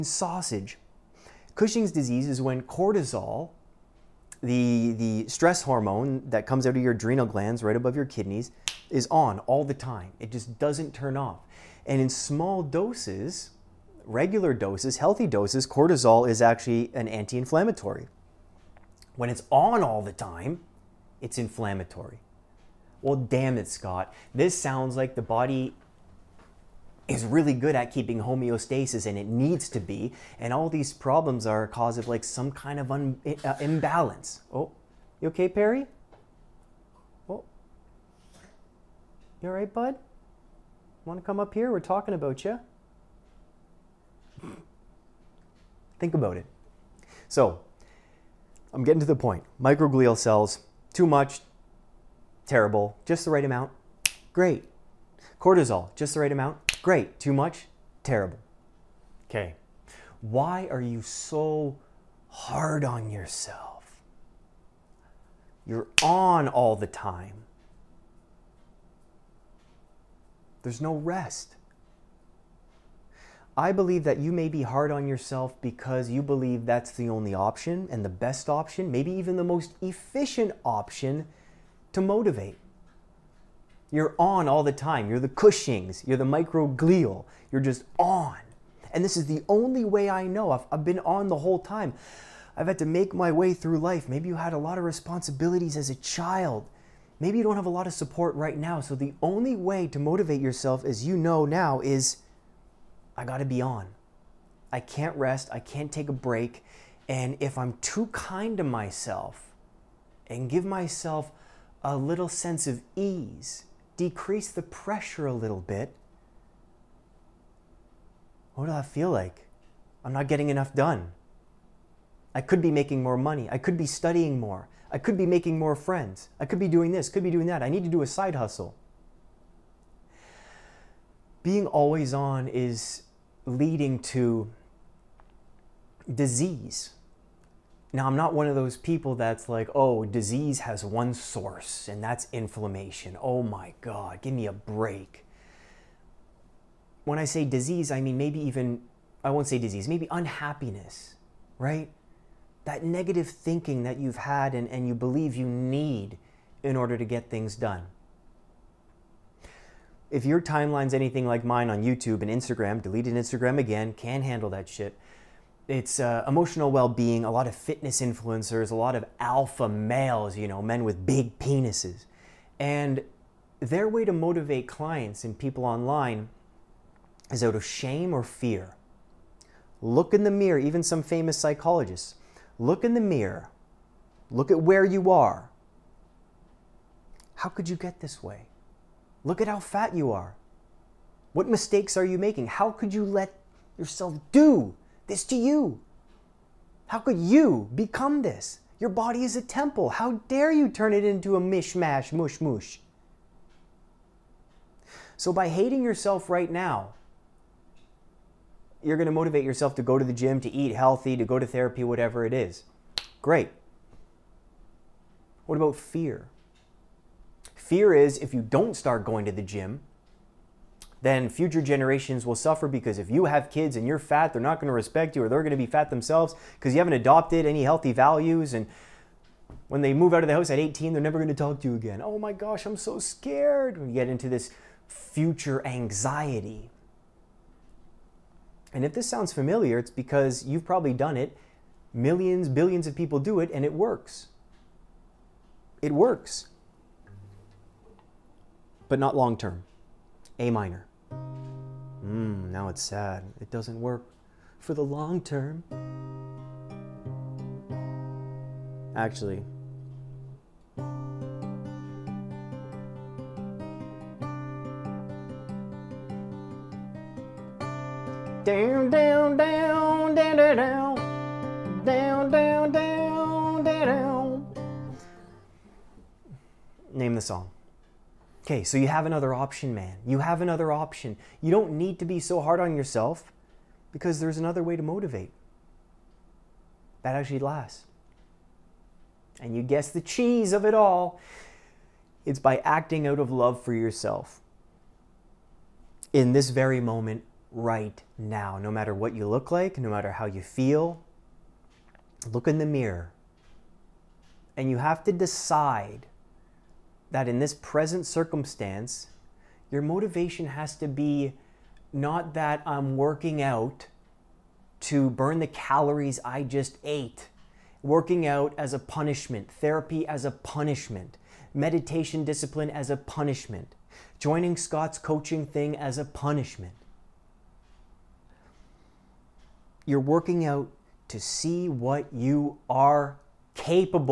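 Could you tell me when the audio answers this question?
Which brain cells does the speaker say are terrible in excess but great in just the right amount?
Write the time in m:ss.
0:49.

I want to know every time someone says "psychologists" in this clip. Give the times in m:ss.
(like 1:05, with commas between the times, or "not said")
3:01.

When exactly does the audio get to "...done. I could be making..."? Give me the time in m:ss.
2:00.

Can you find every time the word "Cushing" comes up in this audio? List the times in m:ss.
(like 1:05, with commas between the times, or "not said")
0:01, 1:25.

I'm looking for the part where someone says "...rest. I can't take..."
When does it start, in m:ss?
1:45.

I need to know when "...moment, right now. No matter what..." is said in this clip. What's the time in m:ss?
4:56.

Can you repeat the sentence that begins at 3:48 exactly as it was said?
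And when they move out of the house at 18, they're never going to talk to you again.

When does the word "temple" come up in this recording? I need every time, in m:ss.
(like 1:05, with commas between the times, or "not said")
3:19.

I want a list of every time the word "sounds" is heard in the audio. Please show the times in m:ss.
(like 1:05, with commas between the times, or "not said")
0:24, 3:59.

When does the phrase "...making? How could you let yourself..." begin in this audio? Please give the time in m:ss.
3:12.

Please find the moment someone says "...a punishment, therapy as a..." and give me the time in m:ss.
5:18.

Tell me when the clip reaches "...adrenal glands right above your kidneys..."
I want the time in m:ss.
0:06.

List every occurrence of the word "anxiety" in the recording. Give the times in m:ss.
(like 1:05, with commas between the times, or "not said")
3:55.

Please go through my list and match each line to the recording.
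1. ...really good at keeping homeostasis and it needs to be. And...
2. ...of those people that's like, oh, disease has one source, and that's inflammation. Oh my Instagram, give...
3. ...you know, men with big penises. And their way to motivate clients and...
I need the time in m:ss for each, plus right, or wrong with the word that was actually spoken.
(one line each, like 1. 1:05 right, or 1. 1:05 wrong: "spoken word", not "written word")
1. 0:27 right
2. 2:18 wrong: "God", not "Instagram"
3. 2:50 right.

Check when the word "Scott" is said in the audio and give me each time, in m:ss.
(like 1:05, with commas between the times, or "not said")
0:23, 5:24.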